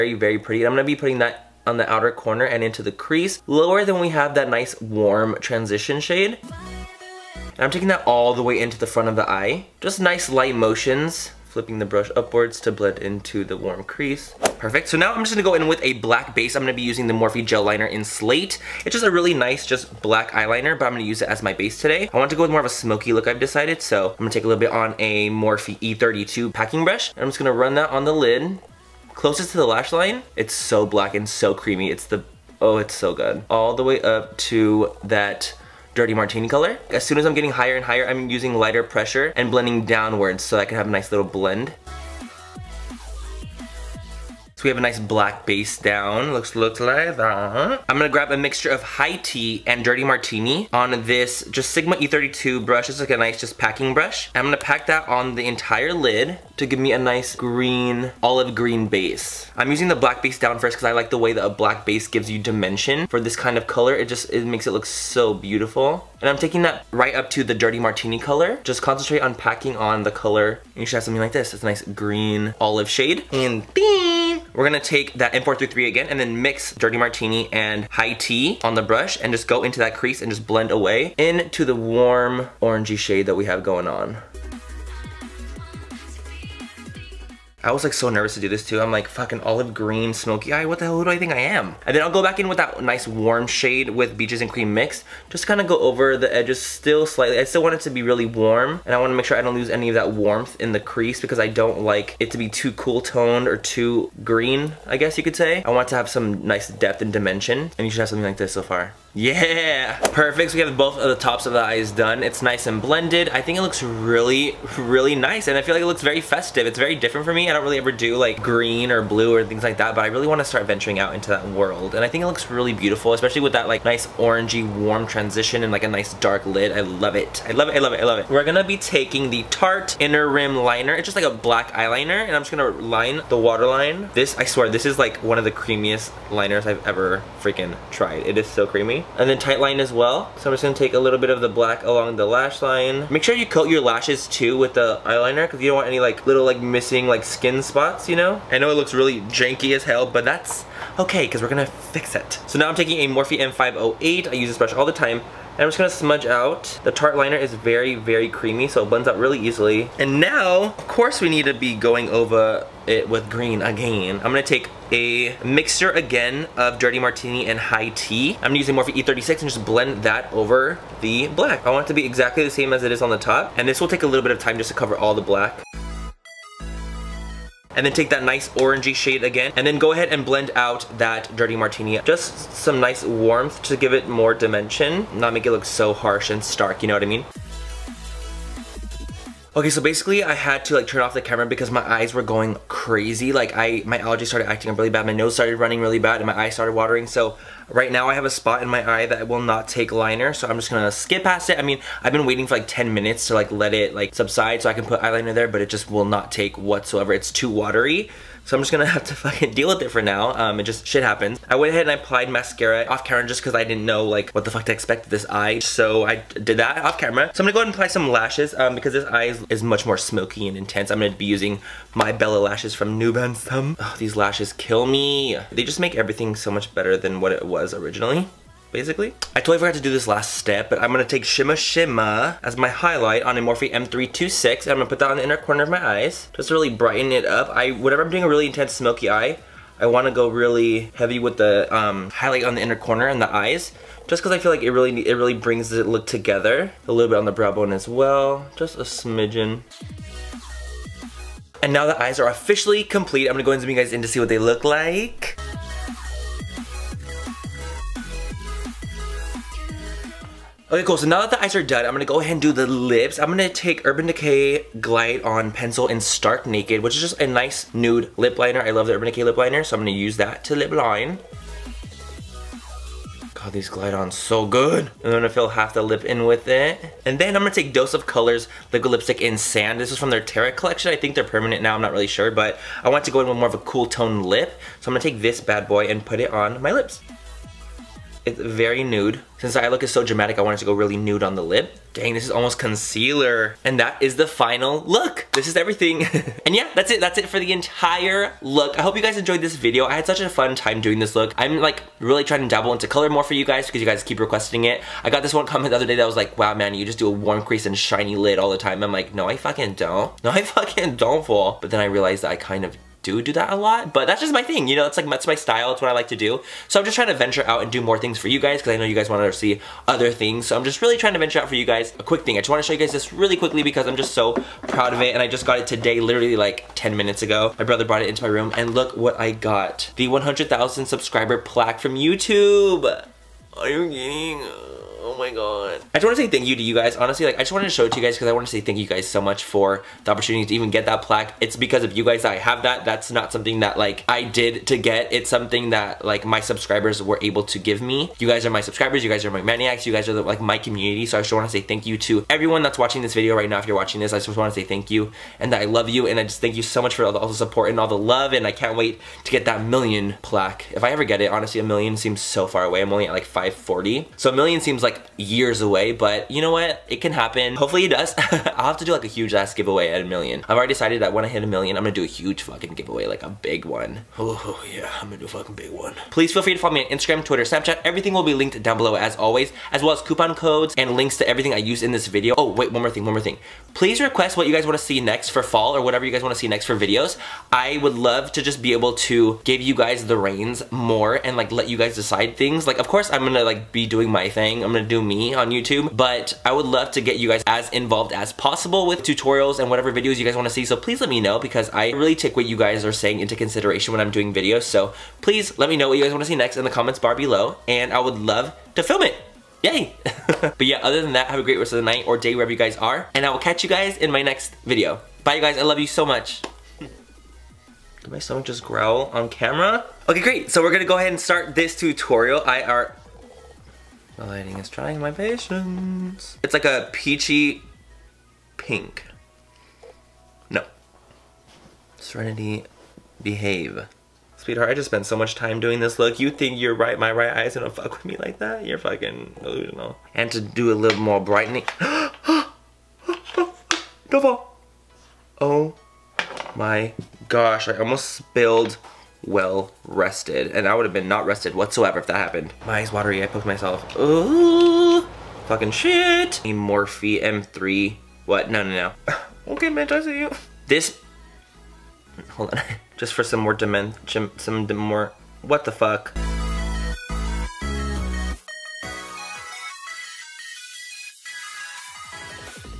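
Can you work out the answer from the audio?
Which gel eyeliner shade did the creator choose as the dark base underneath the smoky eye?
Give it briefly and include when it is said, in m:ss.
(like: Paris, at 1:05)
Slate, at 0:18.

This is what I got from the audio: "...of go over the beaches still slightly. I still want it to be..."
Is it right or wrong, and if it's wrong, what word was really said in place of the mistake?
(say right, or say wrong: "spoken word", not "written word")
wrong: "edges", not "beaches".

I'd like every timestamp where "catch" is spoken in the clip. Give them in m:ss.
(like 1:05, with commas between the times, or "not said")
6:53.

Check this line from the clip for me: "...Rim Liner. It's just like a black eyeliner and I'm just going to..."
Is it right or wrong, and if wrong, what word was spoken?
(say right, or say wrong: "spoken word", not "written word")
right.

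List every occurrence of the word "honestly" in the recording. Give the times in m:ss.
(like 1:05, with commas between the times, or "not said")
5:36, 6:01.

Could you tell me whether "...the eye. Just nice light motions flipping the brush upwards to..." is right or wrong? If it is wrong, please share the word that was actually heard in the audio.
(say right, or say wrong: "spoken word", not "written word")
right.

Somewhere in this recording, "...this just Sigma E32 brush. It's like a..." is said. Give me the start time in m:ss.
0:51.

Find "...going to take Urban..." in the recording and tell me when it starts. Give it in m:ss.
4:23.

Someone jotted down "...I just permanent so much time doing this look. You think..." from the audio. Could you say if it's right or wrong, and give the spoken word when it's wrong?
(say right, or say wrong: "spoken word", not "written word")
wrong: "spent", not "permanent".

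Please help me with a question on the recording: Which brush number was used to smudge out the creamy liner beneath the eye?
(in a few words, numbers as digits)
M508.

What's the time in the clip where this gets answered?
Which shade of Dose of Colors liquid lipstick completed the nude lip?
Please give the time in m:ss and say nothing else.
4:39.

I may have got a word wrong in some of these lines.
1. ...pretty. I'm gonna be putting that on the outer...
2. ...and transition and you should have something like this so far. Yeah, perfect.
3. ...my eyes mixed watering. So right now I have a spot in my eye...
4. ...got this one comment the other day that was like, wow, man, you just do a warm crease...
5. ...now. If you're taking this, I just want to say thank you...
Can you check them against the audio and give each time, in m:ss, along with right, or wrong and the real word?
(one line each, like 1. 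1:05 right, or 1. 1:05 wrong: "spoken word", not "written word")
1. 0:00 right
2. 1:47 wrong: "dimension", not "transition"
3. 3:16 wrong: "started", not "mixed"
4. 5:05 right
5. 5:53 wrong: "watching", not "taking".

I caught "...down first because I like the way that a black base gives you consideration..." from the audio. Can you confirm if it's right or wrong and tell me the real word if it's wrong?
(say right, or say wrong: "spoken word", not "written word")
wrong: "dimension", not "consideration".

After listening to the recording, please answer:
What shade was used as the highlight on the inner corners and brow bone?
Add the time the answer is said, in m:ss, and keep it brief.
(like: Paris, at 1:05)
Shima Shima, at 3:51.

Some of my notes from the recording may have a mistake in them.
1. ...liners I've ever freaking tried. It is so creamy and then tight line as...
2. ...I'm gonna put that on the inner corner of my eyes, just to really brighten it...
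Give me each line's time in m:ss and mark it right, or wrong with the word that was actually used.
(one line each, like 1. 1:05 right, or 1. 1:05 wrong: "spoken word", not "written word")
1. 2:16 right
2. 3:54 right.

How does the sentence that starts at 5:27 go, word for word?
My brother brought it into my room, and look what I got.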